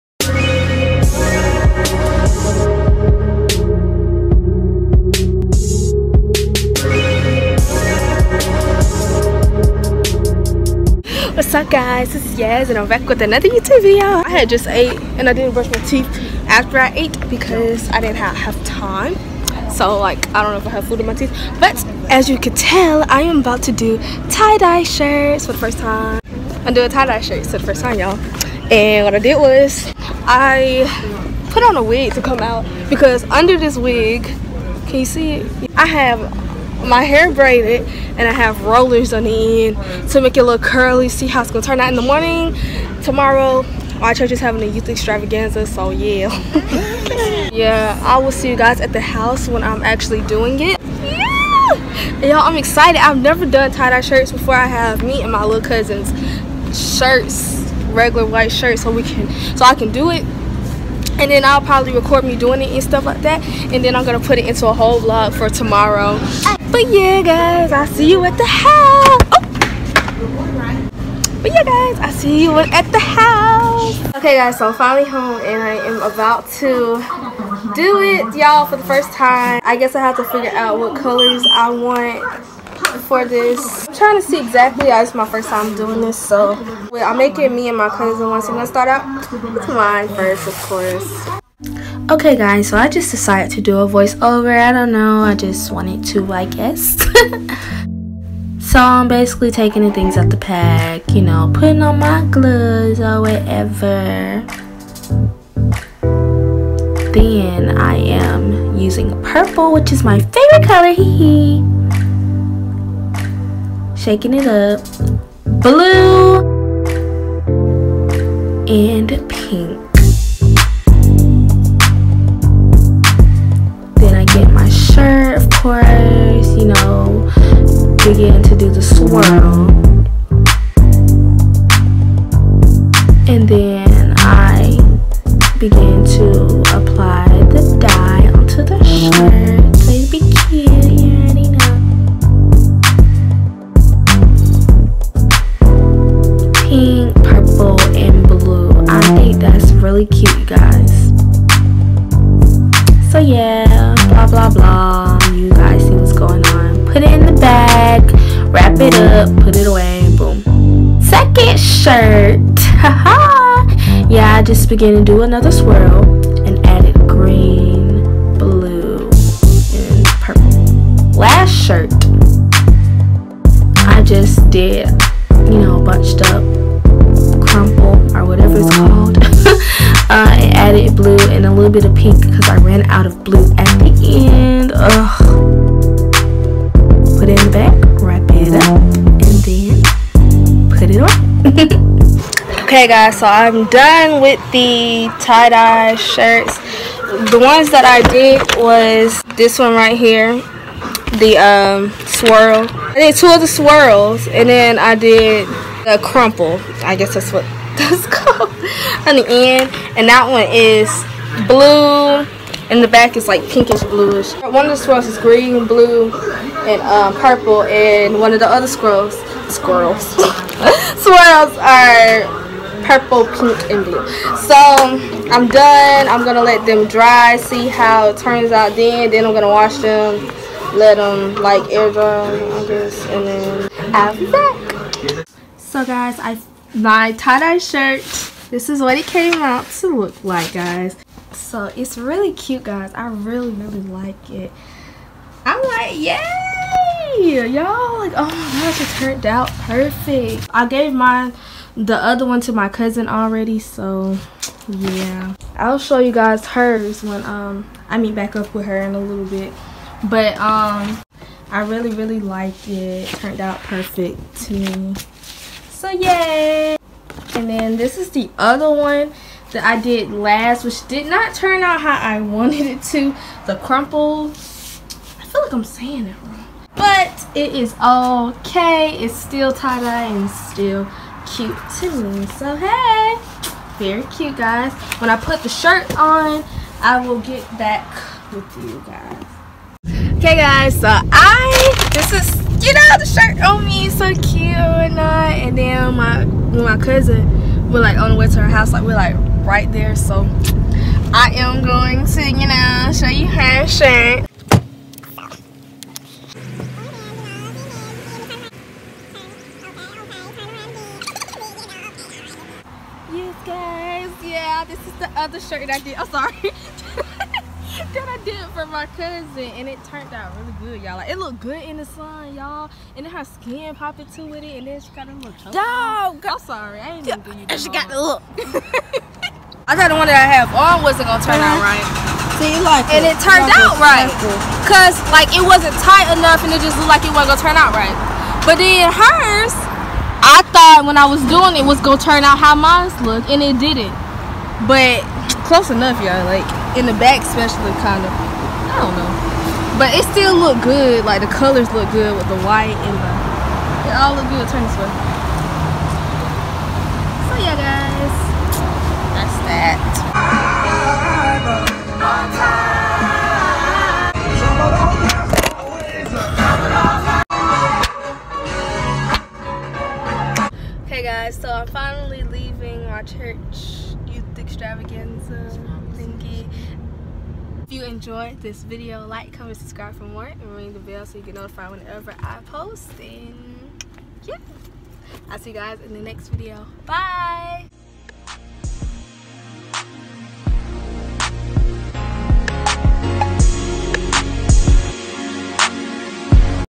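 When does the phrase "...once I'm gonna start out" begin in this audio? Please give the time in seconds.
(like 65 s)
88 s.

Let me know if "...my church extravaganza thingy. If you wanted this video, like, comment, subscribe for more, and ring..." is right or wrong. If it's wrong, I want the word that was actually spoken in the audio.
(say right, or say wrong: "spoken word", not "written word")
wrong: "enjoyed", not "wanted".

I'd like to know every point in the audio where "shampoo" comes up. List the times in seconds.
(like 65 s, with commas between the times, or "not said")
not said.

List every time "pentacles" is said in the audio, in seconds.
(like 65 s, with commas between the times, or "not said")
not said.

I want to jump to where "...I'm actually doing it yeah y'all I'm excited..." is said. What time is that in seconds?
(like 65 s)
49 s.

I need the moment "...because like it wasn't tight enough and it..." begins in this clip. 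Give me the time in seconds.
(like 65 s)
334 s.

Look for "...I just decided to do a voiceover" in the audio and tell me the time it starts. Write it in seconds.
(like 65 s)
92 s.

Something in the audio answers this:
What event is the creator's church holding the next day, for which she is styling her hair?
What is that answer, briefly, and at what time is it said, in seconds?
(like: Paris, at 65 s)
Youth extravaganza, at 44 s.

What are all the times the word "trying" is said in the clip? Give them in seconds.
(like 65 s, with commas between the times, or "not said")
83 s.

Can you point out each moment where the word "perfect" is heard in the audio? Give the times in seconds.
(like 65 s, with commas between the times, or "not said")
249 s, 263 s.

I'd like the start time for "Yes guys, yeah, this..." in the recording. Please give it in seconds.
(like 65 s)
313 s.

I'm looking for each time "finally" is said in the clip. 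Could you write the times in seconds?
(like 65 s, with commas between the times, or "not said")
74 s, 371 s.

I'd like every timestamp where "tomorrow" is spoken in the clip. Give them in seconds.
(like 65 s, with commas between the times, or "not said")
43 s, 65 s.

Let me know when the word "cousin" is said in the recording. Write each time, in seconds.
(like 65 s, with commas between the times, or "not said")
55 s, 87 s, 252 s, 296 s, 318 s.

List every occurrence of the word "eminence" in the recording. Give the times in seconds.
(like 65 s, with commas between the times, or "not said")
not said.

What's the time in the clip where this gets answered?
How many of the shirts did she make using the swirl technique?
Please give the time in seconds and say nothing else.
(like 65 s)
203 s.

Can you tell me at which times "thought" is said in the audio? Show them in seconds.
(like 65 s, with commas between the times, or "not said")
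329 s, 340 s.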